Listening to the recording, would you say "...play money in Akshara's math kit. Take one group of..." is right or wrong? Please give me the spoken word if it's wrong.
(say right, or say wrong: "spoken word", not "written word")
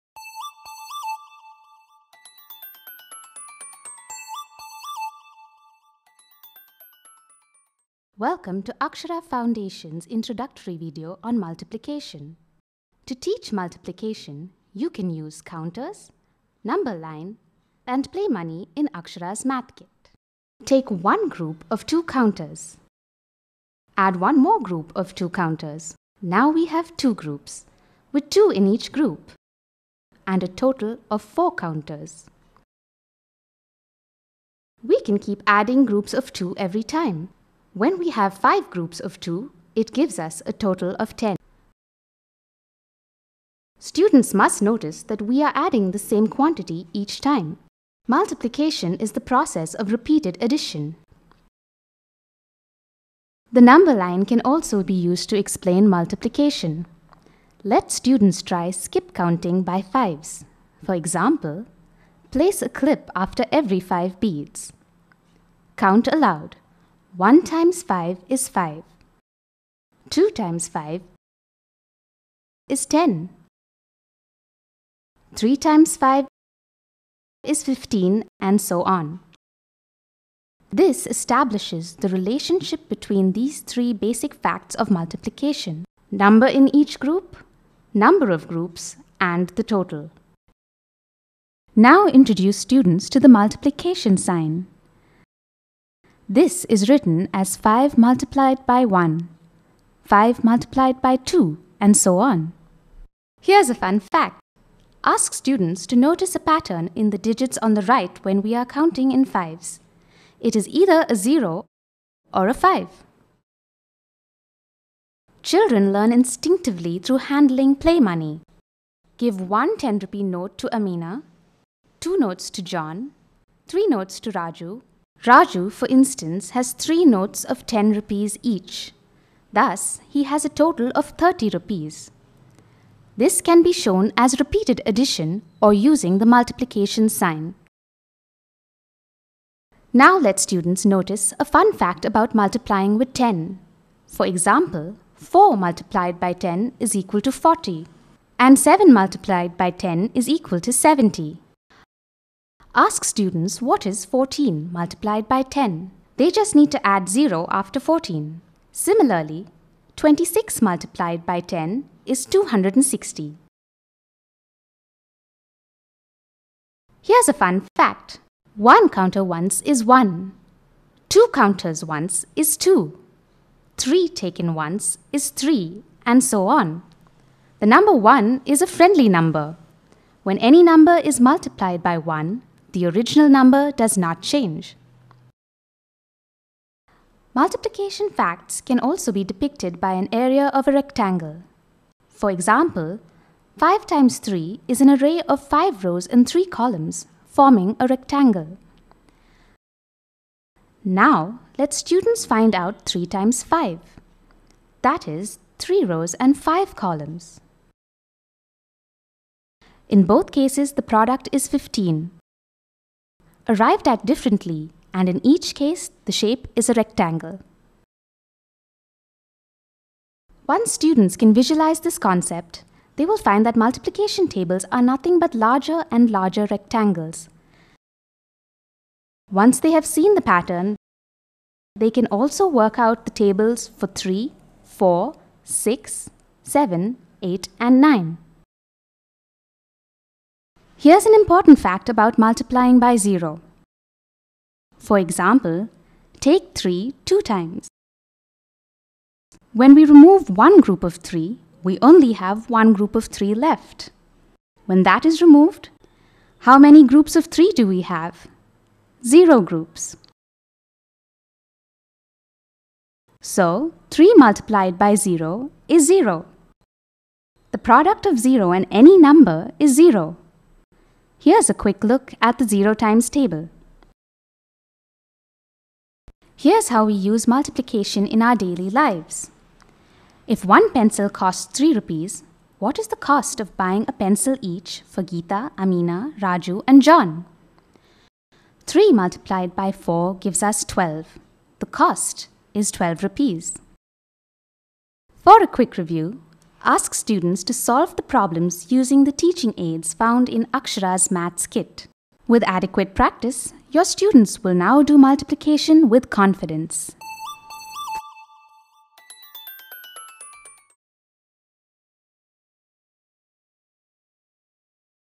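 right.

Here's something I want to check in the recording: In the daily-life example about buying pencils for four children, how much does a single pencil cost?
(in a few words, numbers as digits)
3 rupees.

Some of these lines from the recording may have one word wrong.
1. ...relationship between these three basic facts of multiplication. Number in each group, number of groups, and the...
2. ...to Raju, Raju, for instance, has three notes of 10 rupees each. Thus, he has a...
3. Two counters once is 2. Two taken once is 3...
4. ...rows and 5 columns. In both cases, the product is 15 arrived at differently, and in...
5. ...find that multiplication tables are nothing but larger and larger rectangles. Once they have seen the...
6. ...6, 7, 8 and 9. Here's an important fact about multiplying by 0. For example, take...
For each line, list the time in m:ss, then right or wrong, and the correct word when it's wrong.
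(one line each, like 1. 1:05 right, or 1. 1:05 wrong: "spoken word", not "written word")
1. 1:22 right
2. 2:04 right
3. 2:51 wrong: "Three", not "Two"
4. 3:25 right
5. 3:43 right
6. 3:55 right.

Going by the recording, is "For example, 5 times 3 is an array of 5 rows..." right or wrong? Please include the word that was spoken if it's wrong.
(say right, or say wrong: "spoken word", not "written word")
right.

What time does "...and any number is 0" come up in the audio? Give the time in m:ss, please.
4:28.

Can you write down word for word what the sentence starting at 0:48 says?
Multiplication is the process of repeated addition.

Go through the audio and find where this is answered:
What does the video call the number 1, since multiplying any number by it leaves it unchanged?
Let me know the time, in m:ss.
2:58.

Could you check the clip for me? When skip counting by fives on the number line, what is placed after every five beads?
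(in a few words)
a clip.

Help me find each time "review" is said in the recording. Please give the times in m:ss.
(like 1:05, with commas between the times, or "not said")
4:55.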